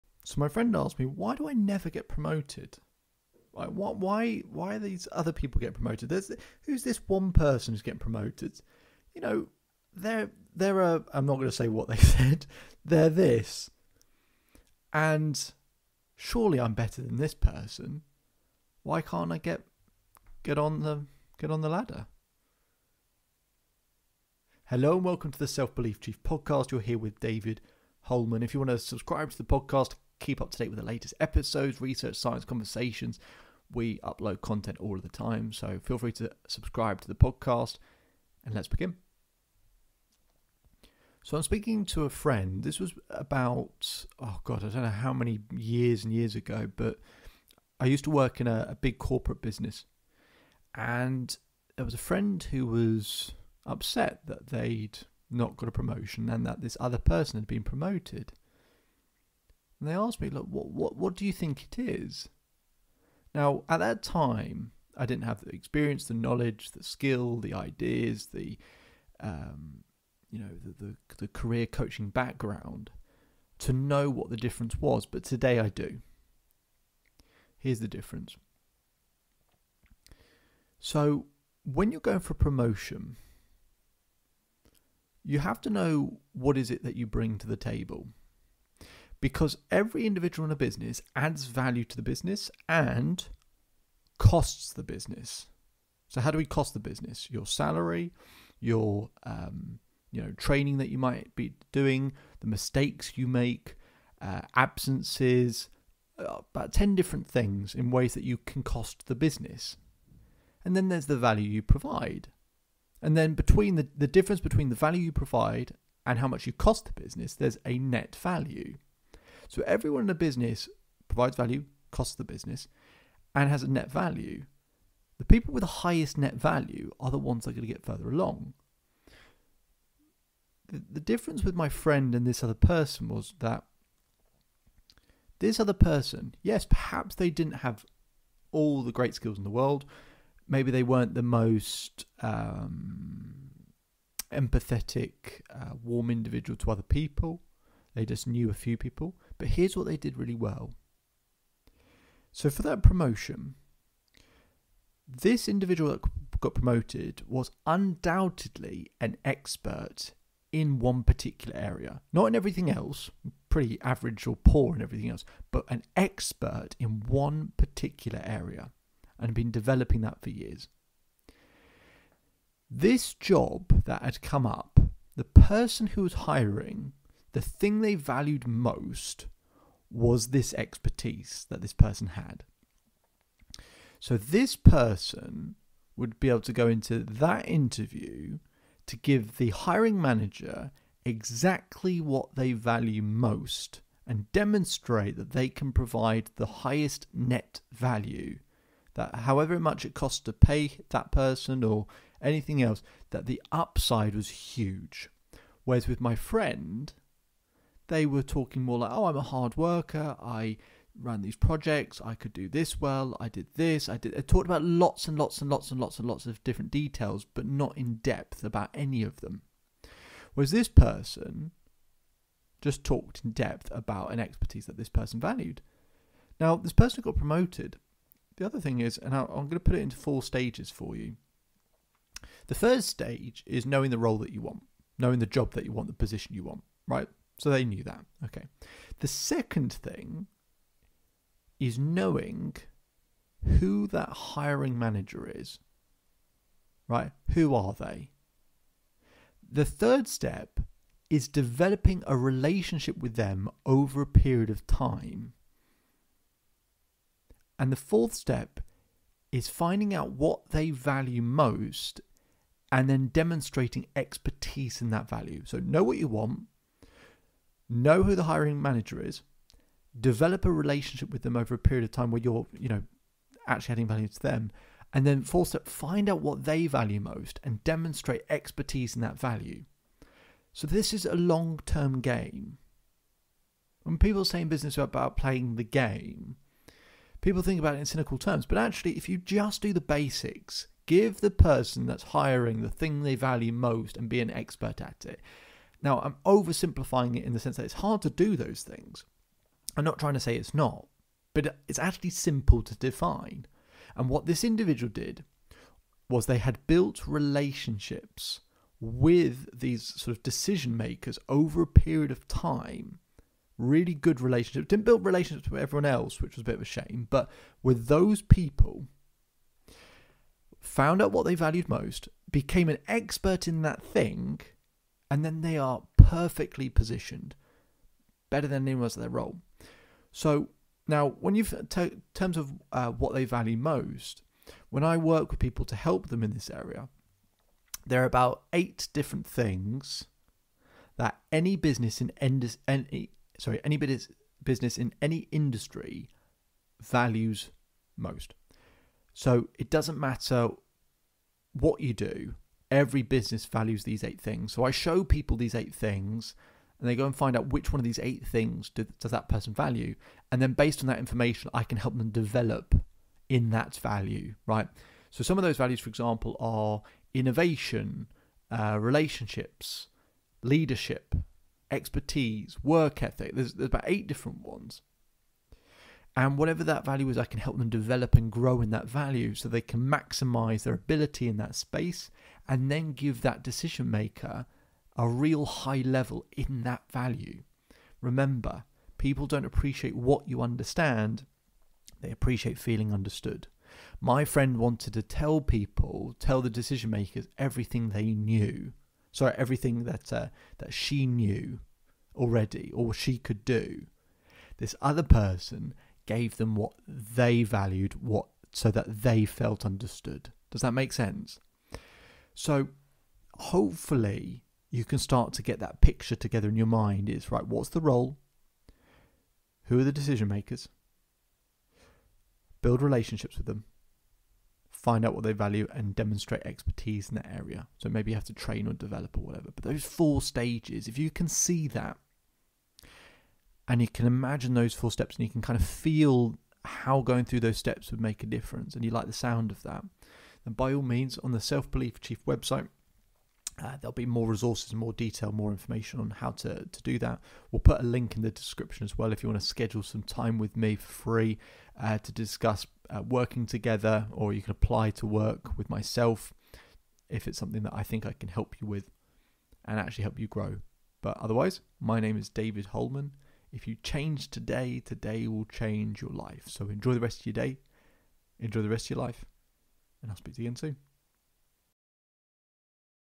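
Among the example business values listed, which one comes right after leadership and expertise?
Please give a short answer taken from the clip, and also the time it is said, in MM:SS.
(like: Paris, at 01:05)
work ethic, at 06:12.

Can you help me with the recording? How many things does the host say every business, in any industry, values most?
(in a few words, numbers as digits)
8.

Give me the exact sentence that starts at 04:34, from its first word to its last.
And then fourth step, find out what they value most and demonstrate expertise in that value.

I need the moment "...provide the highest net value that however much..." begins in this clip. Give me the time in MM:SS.
03:15.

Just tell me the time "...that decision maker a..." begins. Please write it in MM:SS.
06:23.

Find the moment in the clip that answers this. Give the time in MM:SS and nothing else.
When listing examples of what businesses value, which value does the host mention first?
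06:07.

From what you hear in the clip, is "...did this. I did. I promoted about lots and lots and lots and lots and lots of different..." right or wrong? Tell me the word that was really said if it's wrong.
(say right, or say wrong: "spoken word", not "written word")
wrong: "talked", not "promoted".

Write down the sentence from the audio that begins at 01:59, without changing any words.
So everyone in a business provides value, costs the business, and has a net value.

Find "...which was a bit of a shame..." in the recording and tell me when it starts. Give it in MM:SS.
05:16.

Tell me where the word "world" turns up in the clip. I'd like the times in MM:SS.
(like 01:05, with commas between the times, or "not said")
02:19.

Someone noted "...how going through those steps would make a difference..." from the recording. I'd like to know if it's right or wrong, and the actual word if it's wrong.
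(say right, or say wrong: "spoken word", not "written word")
right.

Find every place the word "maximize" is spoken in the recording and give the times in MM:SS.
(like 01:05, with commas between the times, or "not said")
06:19.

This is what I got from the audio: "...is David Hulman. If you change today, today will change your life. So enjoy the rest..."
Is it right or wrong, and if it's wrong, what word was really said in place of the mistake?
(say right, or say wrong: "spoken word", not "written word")
right.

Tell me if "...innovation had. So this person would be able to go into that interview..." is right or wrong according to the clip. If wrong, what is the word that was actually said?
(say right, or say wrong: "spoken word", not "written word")
wrong: "person", not "innovation".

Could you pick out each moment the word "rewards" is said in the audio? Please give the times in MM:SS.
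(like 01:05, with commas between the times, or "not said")
not said.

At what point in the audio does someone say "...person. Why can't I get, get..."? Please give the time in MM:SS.
00:17.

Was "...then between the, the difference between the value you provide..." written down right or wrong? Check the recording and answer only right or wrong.
right.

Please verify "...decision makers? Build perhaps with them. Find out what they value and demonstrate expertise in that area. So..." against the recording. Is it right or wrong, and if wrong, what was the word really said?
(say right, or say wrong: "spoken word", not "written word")
wrong: "relationships", not "perhaps".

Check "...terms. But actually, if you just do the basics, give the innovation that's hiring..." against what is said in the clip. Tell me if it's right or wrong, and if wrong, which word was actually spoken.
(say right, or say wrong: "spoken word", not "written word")
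wrong: "person", not "innovation".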